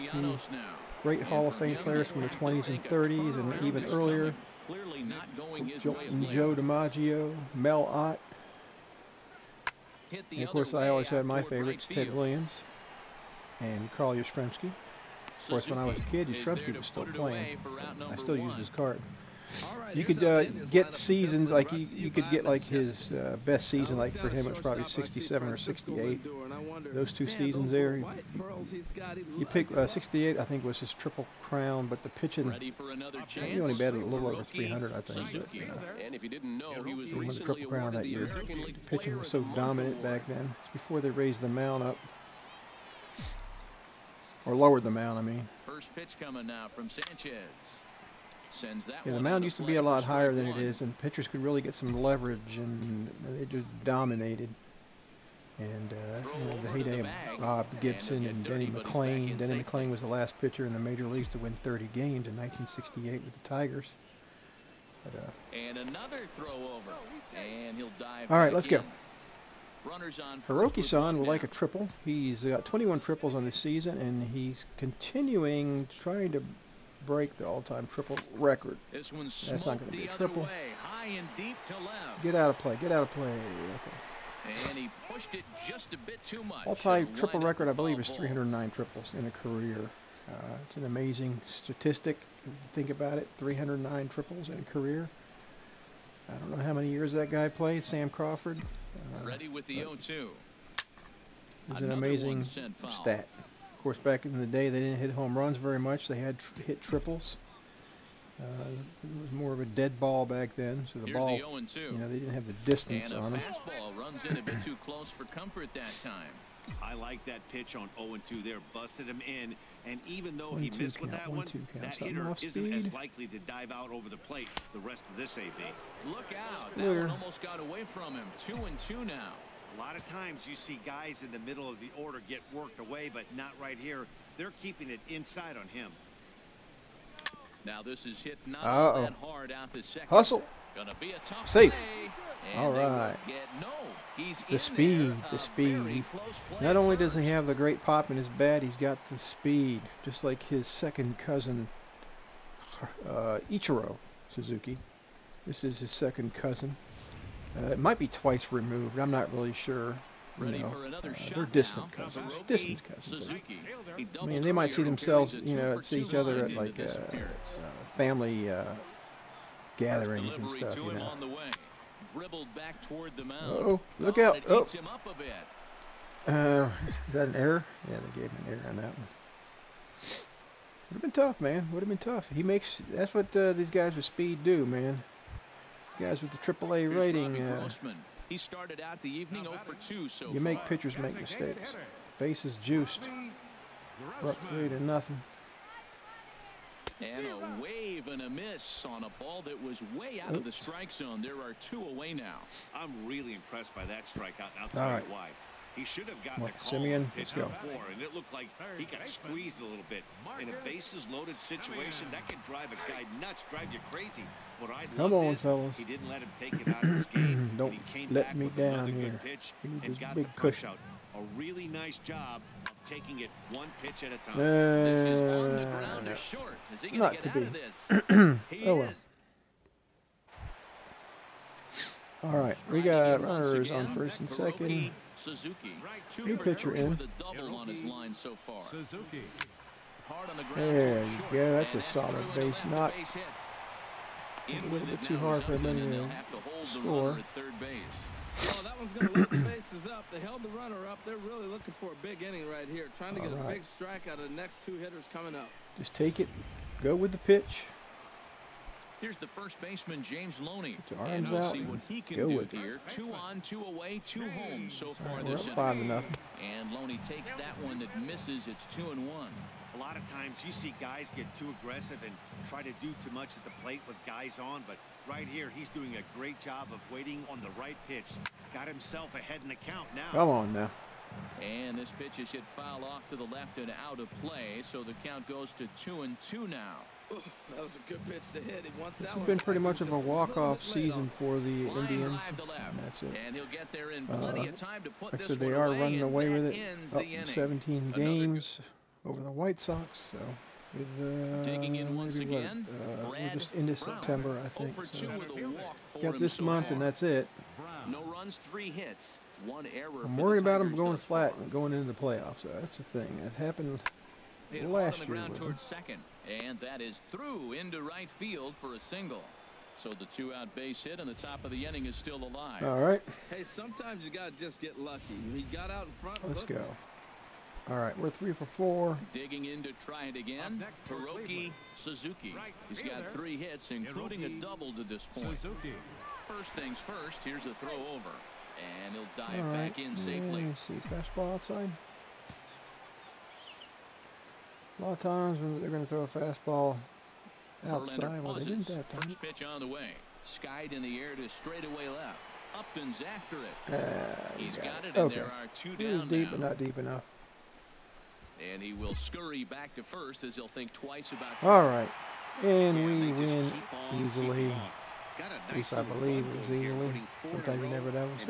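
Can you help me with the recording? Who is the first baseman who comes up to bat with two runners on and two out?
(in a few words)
James Loney.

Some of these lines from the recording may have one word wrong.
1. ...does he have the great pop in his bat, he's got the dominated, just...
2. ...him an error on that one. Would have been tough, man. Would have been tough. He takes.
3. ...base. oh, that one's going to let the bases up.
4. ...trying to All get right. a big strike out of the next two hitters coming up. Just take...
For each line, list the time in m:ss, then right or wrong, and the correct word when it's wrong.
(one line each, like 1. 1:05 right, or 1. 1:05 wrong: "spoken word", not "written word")
1. 2:26 wrong: "speed", not "dominated"
2. 2:58 wrong: "makes", not "takes"
3. 4:07 right
4. 4:12 right.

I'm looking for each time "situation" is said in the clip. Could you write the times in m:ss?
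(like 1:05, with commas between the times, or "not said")
3:31.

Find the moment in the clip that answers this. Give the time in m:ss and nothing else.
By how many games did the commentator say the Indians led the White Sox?
4:57.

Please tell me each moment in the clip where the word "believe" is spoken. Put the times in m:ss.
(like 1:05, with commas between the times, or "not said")
1:27, 6:05.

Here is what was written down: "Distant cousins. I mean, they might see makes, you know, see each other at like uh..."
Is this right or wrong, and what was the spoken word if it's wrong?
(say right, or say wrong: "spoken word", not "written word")
wrong: "themselves", not "makes".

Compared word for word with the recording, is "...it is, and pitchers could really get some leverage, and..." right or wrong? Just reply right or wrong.
right.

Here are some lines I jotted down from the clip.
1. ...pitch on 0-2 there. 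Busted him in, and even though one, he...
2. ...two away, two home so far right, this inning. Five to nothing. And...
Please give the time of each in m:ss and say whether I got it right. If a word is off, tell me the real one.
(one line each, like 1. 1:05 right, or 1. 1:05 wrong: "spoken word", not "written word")
1. 1:57 right
2. 4:23 right.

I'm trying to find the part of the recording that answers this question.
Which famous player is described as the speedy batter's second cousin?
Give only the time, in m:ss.
2:33.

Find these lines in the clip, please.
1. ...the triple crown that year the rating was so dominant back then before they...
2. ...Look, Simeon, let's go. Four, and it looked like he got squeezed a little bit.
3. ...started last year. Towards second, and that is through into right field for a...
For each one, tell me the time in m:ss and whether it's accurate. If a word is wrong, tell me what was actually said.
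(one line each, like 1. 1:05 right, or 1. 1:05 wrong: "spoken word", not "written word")
1. 0:37 wrong: "pitching", not "rating"
2. 3:26 right
3. 5:13 wrong: "happened", not "started".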